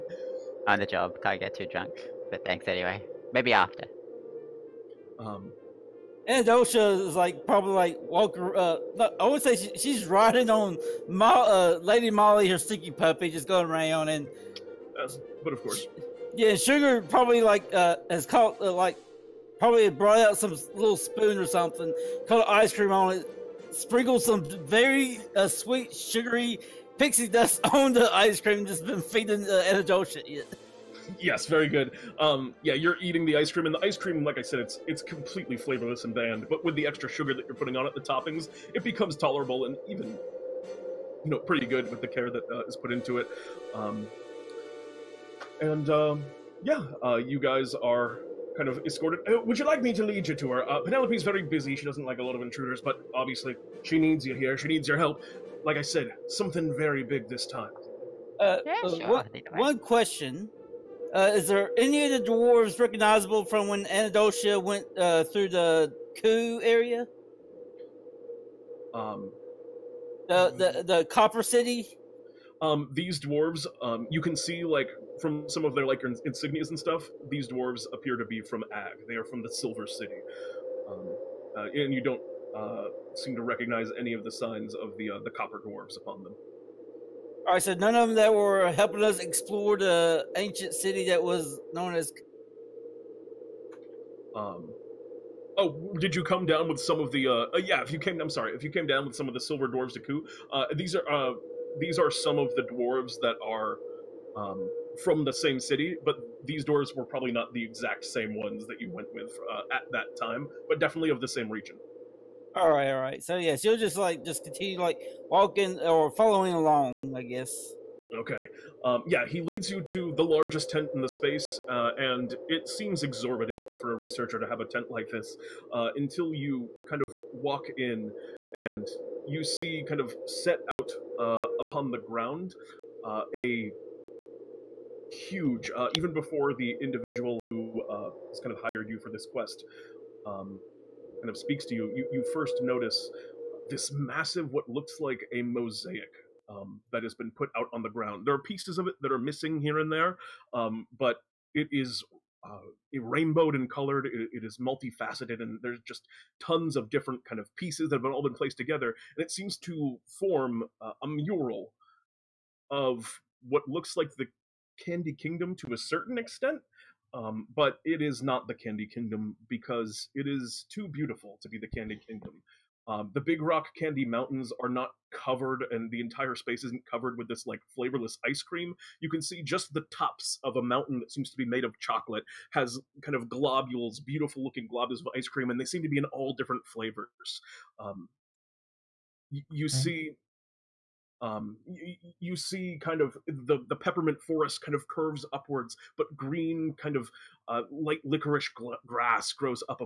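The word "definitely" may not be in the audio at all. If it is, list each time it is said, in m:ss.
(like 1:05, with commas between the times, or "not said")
1:50.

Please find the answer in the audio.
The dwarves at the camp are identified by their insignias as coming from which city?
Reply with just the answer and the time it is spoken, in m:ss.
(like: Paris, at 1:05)
the Silver City, at 1:19.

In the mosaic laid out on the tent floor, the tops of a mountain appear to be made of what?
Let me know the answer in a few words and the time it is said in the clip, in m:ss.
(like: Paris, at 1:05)
Chocolate, at 3:01.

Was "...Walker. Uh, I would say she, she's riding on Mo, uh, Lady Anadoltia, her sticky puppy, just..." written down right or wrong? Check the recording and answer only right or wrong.
wrong.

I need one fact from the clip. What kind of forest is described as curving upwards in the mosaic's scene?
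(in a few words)
Peppermint forest.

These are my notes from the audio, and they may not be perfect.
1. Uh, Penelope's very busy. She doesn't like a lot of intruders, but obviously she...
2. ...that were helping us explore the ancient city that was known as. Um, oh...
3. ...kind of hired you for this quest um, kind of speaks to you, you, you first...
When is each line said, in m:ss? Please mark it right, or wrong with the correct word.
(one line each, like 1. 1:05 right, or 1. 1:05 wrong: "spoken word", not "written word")
1. 0:50 right
2. 1:28 right
3. 2:18 right.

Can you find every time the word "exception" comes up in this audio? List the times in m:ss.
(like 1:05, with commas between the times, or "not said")
not said.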